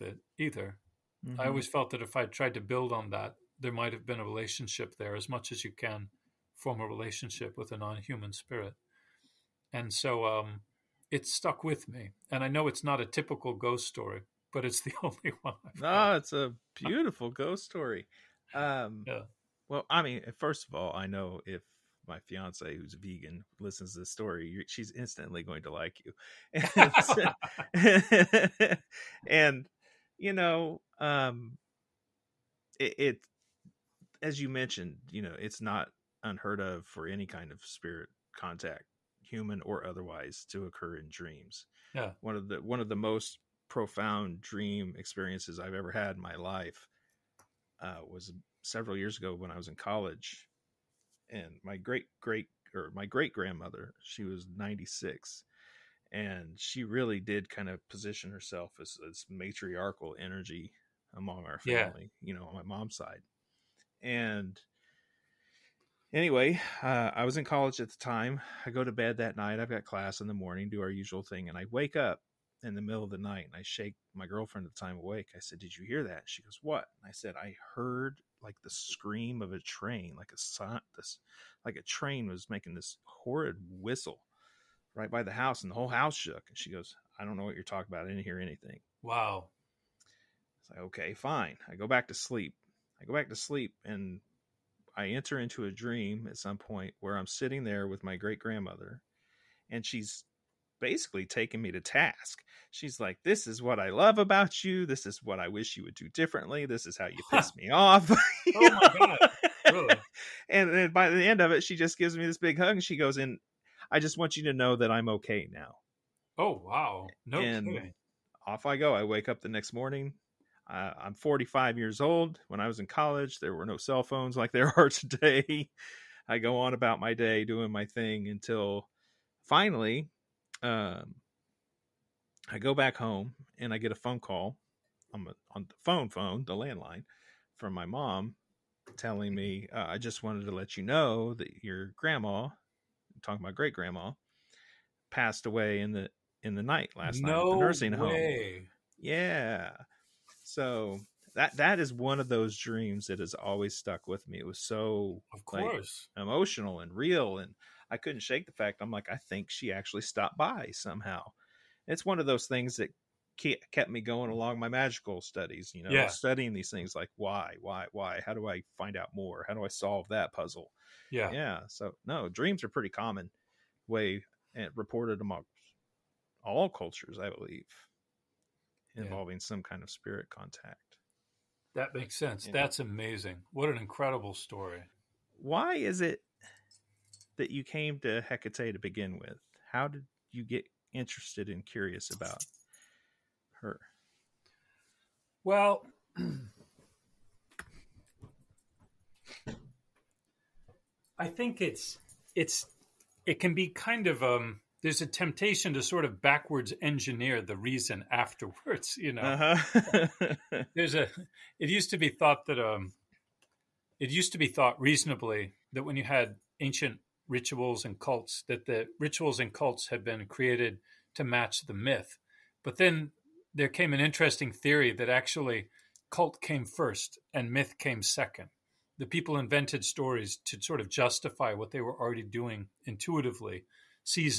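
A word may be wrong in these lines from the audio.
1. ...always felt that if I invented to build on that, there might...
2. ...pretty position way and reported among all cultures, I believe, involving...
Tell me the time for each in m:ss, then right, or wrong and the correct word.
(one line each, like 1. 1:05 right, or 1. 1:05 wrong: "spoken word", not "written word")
1. 0:01 wrong: "tried", not "invented"
2. 2:52 wrong: "common", not "position".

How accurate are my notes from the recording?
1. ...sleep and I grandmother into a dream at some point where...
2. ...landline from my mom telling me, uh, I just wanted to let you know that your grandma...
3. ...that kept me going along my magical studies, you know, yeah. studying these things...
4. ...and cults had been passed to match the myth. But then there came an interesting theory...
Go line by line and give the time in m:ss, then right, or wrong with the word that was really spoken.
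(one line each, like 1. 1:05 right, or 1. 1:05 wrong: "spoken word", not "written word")
1. 1:33 wrong: "enter", not "grandmother"
2. 2:16 right
3. 2:42 right
4. 3:39 wrong: "created", not "passed".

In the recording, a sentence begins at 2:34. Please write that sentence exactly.
It was so of course like, emotional and real and I couldn't shake the fact.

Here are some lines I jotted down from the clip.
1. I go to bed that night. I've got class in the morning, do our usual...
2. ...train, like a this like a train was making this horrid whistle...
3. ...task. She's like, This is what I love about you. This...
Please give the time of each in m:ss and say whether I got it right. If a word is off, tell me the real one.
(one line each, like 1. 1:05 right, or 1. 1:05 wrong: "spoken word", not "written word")
1. 1:08 right
2. 1:19 right
3. 1:41 right.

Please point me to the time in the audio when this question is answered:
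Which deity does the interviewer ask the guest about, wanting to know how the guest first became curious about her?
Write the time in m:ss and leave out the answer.
3:08.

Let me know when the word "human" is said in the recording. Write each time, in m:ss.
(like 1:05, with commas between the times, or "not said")
0:07, 0:39.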